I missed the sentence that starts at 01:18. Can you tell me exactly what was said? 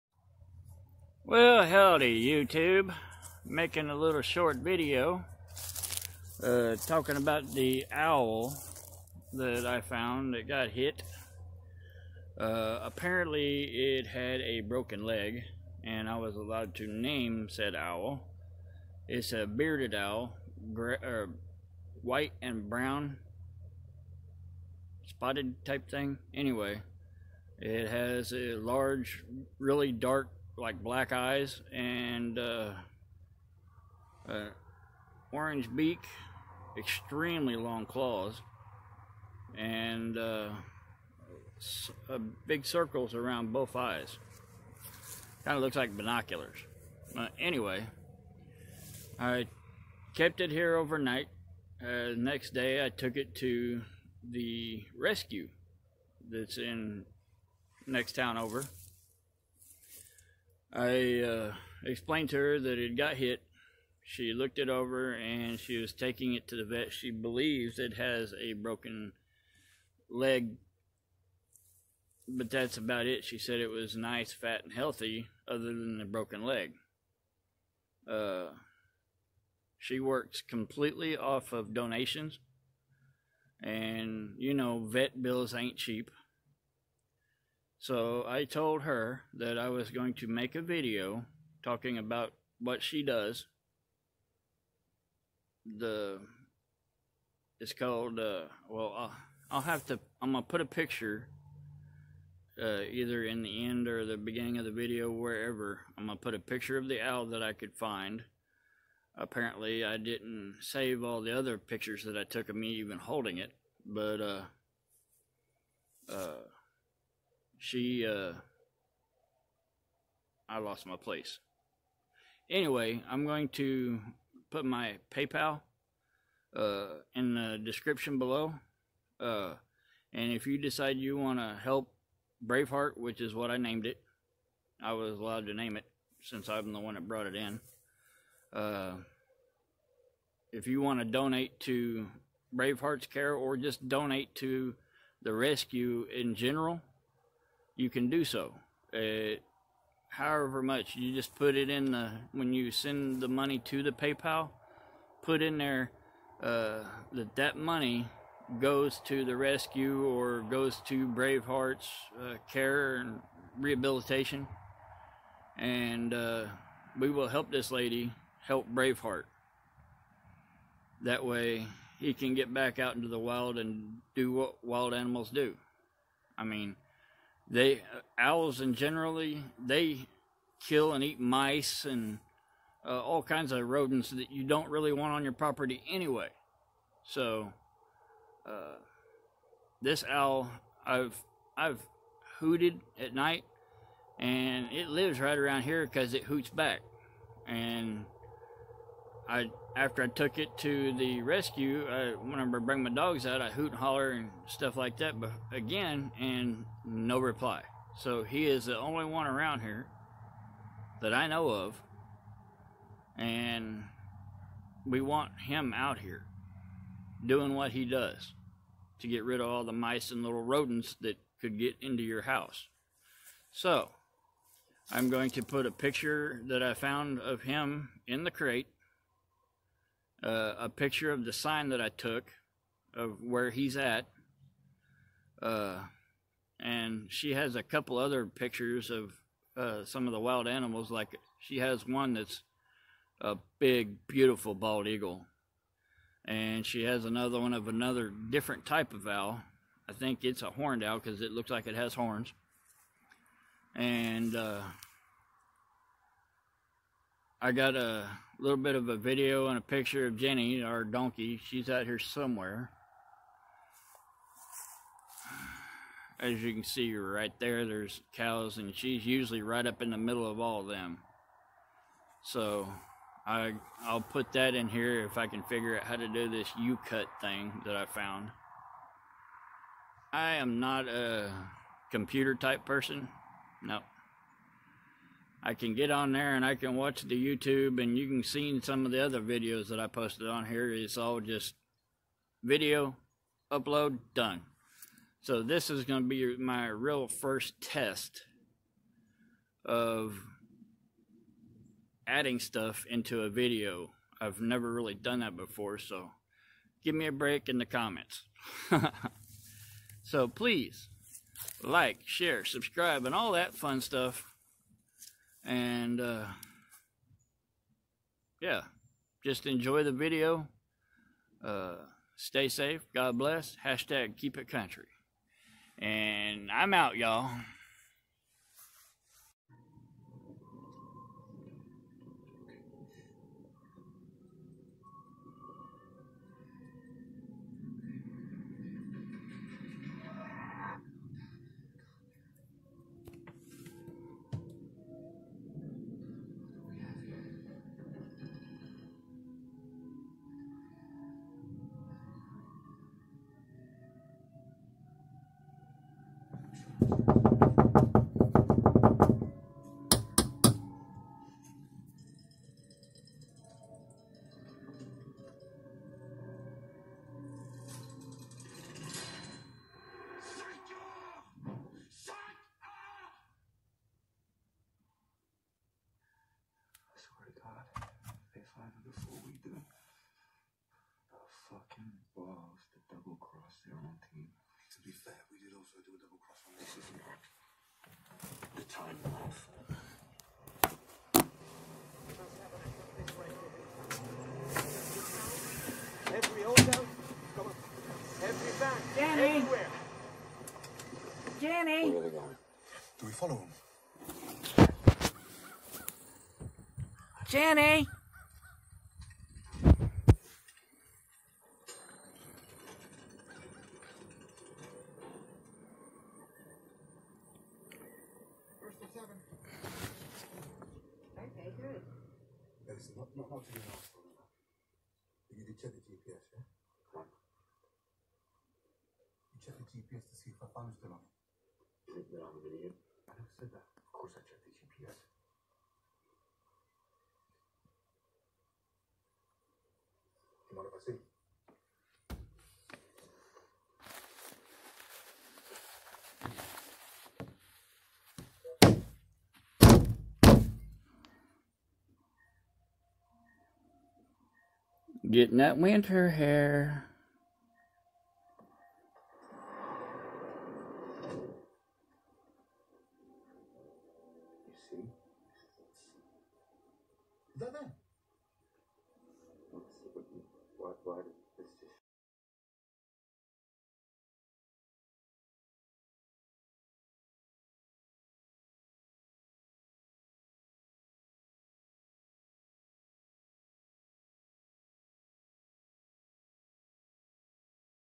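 Uh, she works completely off of donations, and you know, vet bills ain't cheap.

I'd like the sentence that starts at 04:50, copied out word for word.
It's all just video, upload, done.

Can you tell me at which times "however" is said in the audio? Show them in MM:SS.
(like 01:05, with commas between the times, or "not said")
02:30.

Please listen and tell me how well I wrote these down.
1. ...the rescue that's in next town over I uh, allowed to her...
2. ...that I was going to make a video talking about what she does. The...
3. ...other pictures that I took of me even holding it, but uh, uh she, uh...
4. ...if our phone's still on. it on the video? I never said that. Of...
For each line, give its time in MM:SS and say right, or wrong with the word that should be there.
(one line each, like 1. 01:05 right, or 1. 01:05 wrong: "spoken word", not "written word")
1. 00:54 wrong: "explained", not "allowed"
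2. 01:29 right
3. 01:51 right
4. 07:10 right.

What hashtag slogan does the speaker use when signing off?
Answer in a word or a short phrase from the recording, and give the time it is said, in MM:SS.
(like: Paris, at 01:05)
Keep it country, at 05:24.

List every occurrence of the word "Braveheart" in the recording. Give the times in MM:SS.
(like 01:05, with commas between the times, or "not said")
02:12, 02:22, 02:41, 02:48.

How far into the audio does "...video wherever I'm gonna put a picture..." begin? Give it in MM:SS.
01:44.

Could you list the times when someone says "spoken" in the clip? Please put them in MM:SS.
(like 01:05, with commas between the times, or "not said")
not said.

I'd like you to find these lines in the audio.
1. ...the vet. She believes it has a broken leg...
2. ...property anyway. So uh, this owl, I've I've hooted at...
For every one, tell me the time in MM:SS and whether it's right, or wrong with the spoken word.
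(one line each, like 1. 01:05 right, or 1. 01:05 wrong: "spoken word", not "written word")
1. 01:06 right
2. 03:05 right.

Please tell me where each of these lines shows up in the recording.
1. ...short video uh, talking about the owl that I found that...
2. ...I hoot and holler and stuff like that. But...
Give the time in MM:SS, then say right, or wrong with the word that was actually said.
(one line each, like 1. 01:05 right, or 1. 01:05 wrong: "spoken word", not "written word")
1. 00:04 right
2. 03:23 right.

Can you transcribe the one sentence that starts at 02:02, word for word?
Anyway, I'm going to put my PayPal uh, in the description below.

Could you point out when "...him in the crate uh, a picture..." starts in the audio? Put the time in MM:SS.
03:47.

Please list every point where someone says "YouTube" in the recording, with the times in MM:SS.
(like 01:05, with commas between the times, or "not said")
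00:02, 04:47.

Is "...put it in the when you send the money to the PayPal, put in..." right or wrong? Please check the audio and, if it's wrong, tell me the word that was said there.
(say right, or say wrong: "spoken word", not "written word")
right.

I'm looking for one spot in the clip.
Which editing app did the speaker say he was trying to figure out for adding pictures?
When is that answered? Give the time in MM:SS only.
04:36.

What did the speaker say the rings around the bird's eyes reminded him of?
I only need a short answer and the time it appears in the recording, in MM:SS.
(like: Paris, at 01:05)
Binoculars, at 00:45.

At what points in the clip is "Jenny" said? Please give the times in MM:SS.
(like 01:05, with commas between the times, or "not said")
04:20, 06:47.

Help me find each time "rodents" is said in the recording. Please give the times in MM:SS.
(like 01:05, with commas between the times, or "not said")
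03:03, 03:40.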